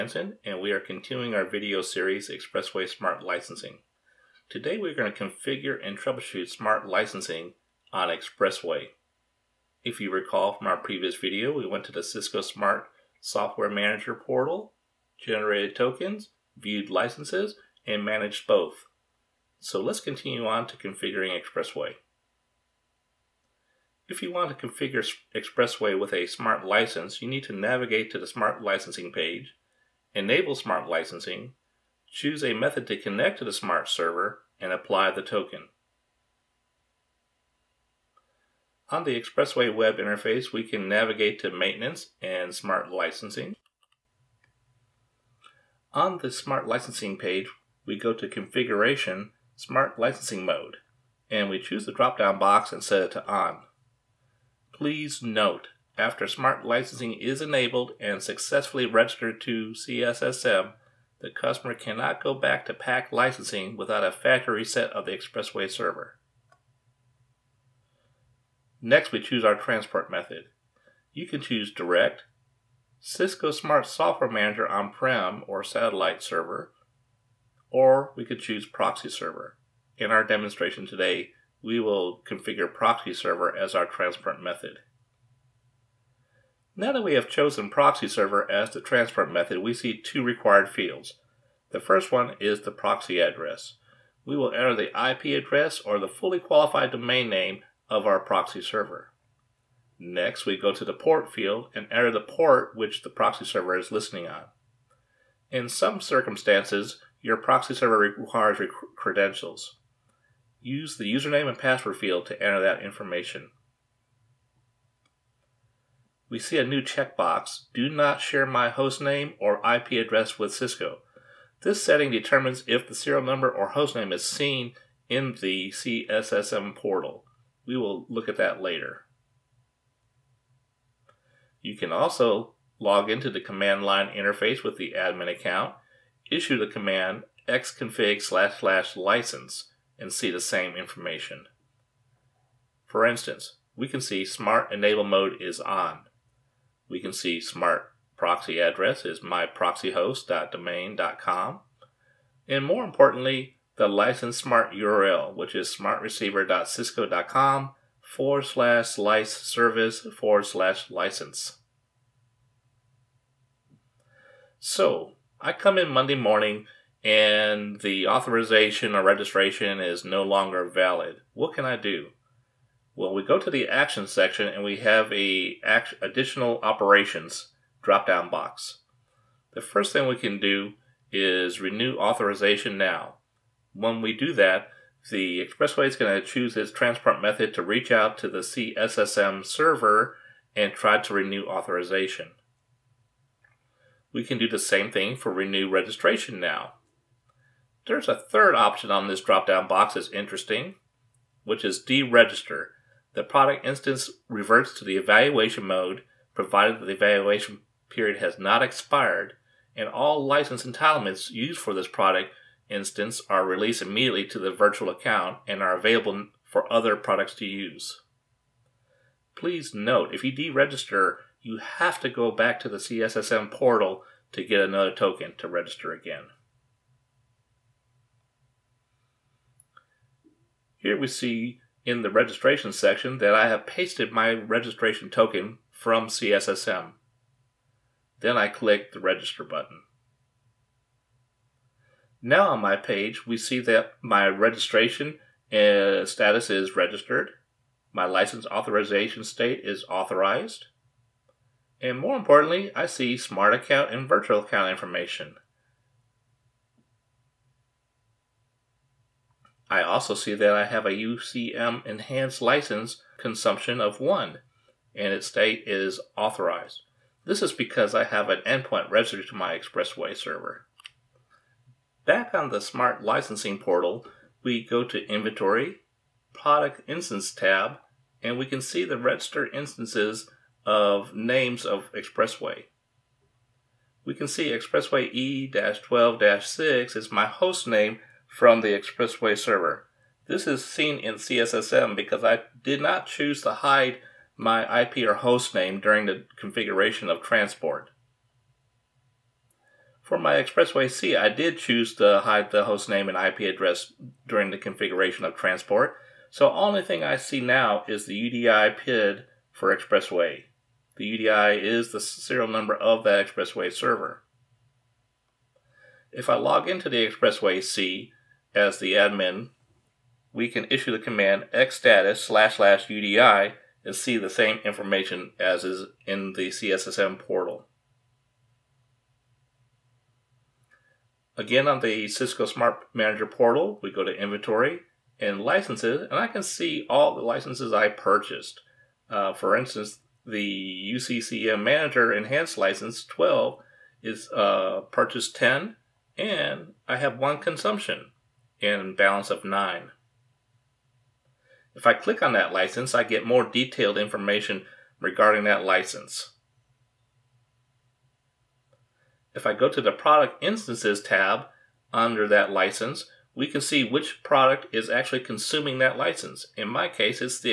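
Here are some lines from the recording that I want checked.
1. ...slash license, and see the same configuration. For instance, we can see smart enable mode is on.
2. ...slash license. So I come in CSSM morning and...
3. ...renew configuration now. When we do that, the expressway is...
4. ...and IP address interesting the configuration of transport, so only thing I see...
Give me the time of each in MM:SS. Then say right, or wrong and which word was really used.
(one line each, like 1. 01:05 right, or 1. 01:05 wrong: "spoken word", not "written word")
1. 02:18 wrong: "information", not "configuration"
2. 02:40 wrong: "Monday", not "CSSM"
3. 03:01 wrong: "authorization", not "configuration"
4. 05:03 wrong: "during", not "interesting".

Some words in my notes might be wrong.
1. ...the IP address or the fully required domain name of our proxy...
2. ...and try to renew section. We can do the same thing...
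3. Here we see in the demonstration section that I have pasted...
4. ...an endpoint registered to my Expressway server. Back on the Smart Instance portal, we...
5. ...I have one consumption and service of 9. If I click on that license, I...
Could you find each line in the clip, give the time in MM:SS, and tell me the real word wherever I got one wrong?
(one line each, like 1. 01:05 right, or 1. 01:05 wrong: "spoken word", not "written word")
1. 01:34 wrong: "qualified", not "required"
2. 03:10 wrong: "authorization", not "section"
3. 03:50 wrong: "registration", not "demonstration"
4. 04:28 wrong: "Licensing", not "Instance"
5. 05:46 wrong: "balance", not "service".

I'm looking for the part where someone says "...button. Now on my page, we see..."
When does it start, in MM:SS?
03:59.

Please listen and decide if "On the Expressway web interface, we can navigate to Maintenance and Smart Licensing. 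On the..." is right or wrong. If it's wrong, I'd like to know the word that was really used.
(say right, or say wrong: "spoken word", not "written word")
right.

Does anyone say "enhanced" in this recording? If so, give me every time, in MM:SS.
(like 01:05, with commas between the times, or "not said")
04:21, 05:42.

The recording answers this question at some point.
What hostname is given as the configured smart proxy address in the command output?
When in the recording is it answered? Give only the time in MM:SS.
02:29.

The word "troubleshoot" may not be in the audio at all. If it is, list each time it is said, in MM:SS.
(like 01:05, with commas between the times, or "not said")
00:05.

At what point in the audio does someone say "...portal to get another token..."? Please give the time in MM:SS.
03:43.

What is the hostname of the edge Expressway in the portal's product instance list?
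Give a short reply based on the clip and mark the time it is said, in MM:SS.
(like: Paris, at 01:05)
Expressway E-12-6, at 04:44.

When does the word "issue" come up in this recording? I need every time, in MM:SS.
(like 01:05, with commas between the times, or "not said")
02:16, 05:20.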